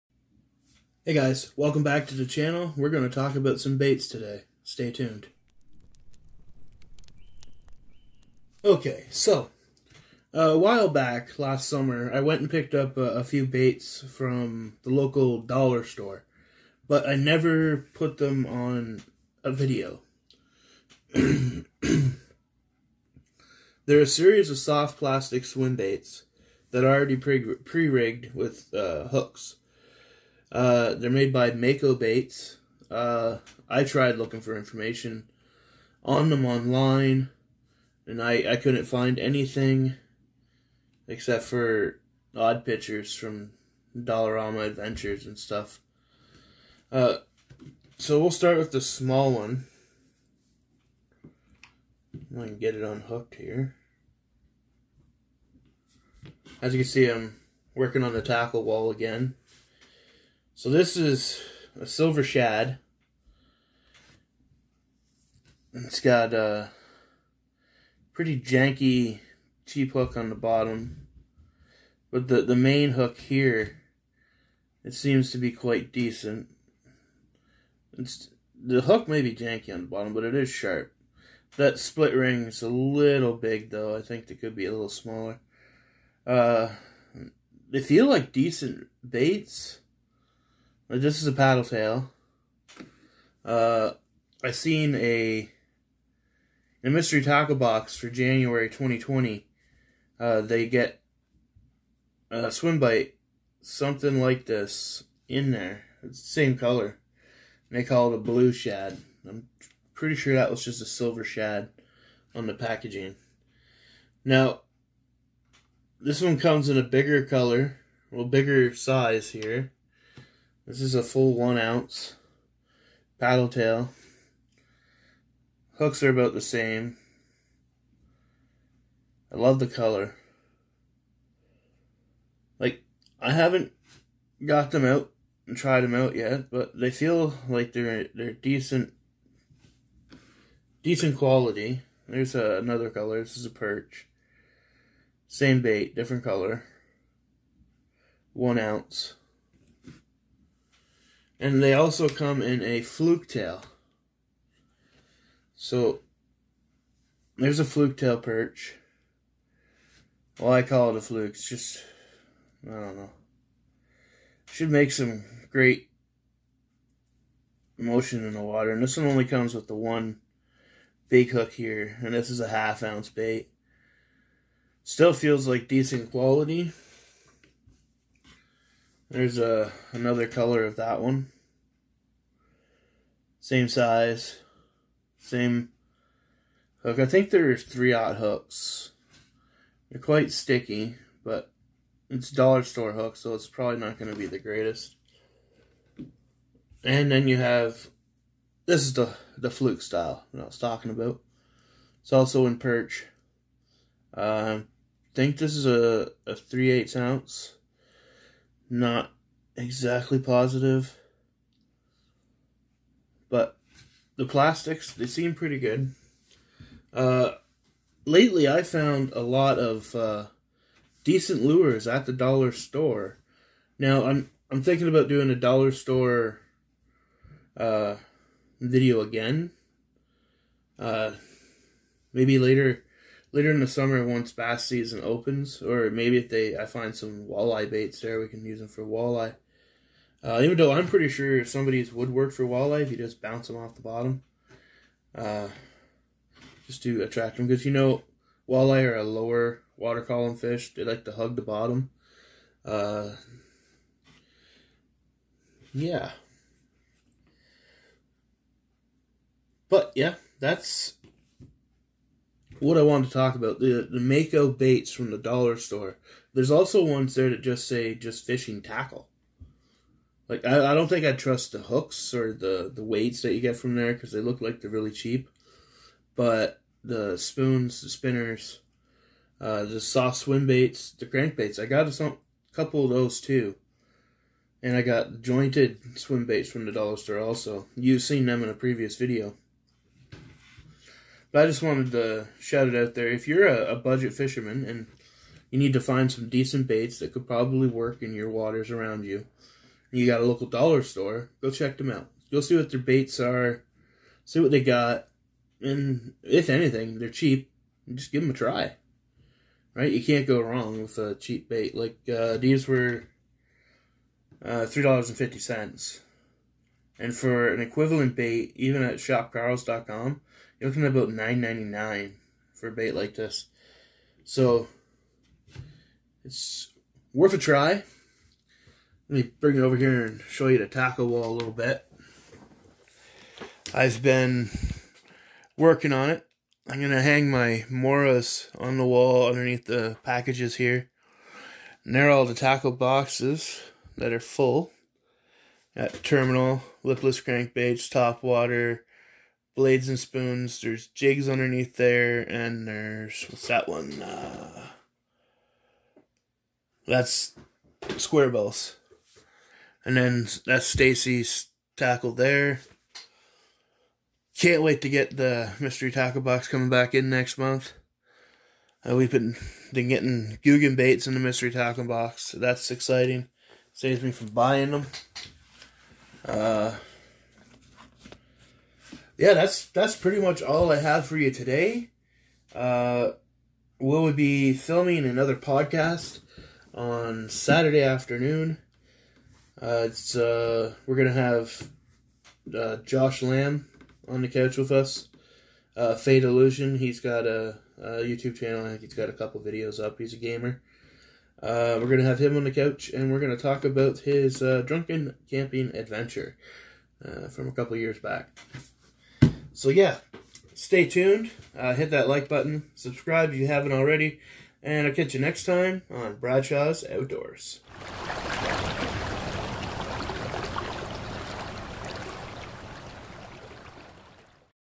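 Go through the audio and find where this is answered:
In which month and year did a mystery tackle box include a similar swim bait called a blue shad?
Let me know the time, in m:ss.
1:38.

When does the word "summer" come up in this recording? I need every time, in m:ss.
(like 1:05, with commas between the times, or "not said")
0:11, 3:53.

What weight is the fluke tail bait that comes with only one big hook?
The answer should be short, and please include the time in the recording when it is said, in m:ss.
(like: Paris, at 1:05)
half ounce, at 2:52.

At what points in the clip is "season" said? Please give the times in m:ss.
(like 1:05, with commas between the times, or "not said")
3:54.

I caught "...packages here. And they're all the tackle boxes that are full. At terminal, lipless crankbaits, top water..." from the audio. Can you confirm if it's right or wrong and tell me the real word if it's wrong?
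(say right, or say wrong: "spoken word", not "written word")
right.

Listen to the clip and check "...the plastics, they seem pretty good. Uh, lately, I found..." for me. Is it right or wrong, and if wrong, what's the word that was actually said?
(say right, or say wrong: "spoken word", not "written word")
right.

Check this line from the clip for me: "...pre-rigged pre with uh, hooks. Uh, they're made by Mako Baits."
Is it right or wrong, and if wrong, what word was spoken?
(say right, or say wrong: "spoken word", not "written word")
right.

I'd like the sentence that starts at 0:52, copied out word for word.
I can get it unhooked here.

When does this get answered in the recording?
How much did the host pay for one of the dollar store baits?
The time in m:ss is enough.
5:14.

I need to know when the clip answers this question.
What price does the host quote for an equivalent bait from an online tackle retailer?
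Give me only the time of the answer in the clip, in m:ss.
5:21.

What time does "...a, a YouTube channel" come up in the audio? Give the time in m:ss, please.
6:37.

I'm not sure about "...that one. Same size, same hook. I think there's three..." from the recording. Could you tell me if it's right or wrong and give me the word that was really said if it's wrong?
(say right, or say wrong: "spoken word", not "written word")
right.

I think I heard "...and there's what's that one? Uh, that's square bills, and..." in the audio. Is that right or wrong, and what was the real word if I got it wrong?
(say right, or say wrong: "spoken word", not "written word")
right.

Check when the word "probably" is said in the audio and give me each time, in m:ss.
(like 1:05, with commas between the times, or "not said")
3:13, 4:57.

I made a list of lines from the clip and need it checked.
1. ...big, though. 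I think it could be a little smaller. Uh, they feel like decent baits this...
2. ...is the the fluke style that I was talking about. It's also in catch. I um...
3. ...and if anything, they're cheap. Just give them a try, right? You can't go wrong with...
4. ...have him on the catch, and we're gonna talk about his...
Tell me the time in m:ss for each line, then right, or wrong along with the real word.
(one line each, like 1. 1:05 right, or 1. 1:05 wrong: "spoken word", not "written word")
1. 1:23 right
2. 3:18 wrong: "perch", not "catch"
3. 5:05 right
4. 6:42 wrong: "couch", not "catch".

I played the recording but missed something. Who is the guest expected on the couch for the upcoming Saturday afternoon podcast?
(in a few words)
Josh Lamb.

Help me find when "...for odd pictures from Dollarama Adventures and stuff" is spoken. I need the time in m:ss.
0:41.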